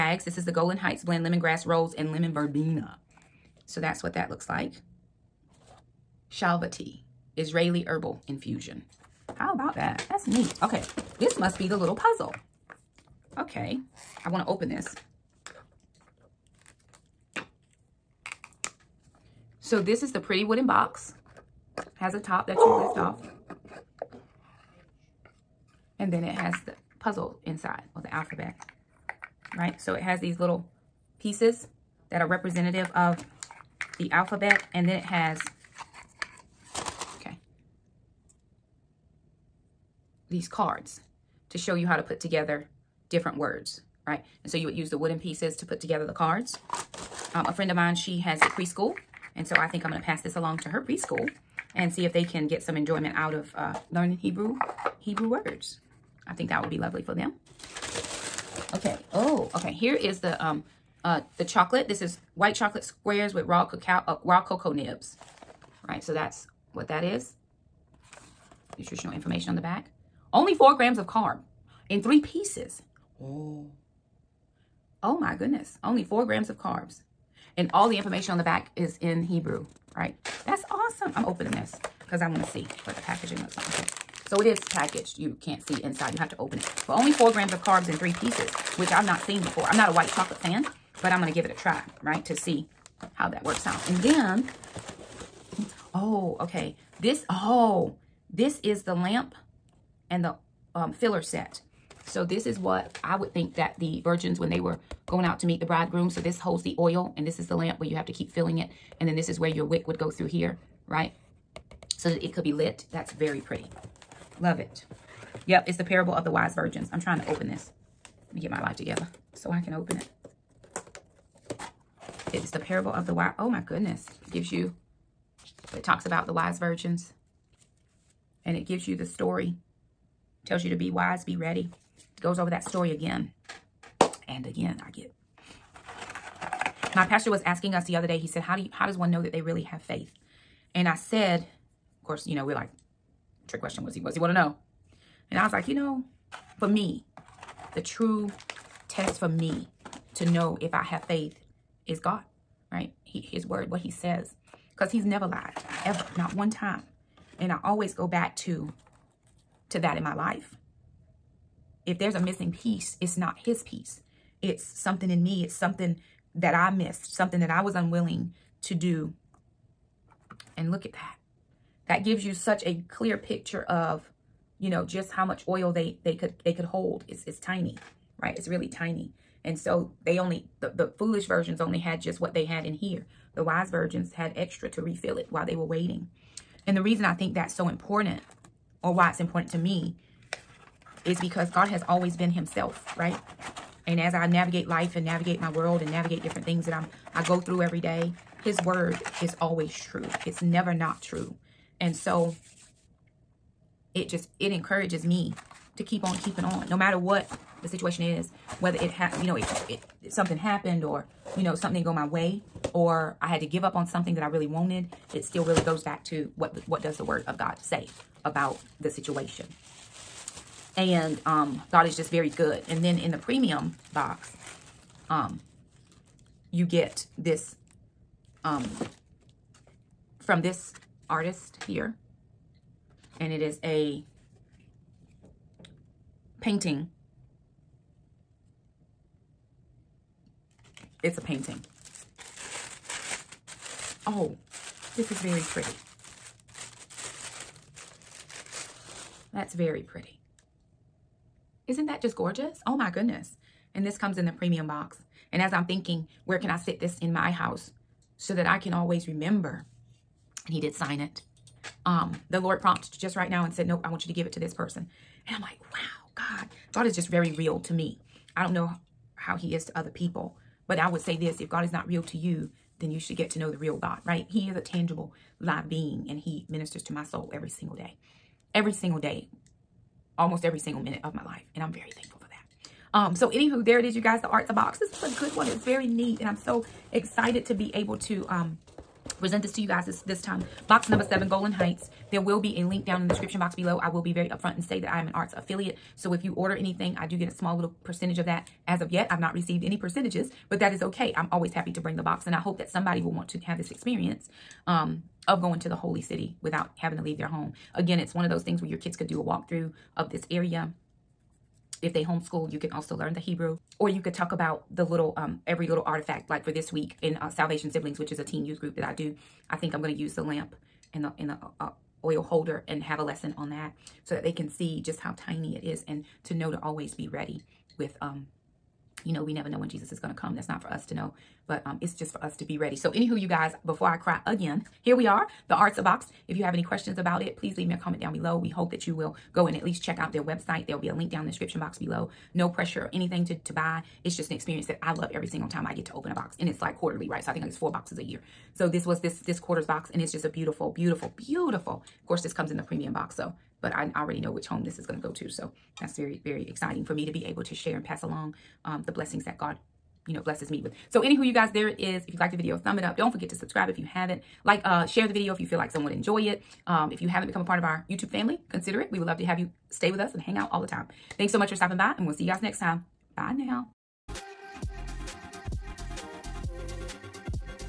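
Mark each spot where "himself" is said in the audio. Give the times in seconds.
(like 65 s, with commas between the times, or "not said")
192 s.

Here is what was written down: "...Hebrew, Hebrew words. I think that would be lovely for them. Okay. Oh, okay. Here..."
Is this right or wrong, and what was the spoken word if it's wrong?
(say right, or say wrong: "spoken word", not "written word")
right.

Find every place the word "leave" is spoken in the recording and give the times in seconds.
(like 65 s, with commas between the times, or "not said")
307 s, 337 s.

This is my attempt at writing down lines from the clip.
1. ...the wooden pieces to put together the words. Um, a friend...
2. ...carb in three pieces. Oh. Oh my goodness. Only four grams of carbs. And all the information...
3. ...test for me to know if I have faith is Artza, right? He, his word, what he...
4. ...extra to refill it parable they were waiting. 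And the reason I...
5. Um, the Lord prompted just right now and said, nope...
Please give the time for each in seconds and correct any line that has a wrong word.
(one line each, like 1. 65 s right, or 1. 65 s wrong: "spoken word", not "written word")
1. 44 s wrong: "cards", not "words"
2. 71 s right
3. 148 s wrong: "God", not "Artza"
4. 184 s wrong: "while", not "parable"
5. 261 s right.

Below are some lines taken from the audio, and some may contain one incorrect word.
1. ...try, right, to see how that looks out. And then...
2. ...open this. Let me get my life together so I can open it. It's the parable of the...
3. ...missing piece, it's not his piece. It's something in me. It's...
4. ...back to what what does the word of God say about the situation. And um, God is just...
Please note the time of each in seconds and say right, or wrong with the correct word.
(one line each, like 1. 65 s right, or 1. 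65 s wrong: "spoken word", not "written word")
1. 91 s wrong: "works", not "looks"
2. 117 s right
3. 162 s right
4. 215 s right.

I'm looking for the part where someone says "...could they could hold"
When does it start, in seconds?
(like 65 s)
176 s.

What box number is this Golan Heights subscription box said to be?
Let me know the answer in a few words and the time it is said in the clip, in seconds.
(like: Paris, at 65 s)
7, at 290 s.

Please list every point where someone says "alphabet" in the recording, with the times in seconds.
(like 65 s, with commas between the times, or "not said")
28 s, 34 s.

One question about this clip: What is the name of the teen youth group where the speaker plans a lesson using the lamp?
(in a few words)
Salvation Siblings.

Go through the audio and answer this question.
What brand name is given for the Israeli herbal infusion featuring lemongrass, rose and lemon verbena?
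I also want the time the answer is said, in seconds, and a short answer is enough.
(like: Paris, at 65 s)
Shalva, at 6 s.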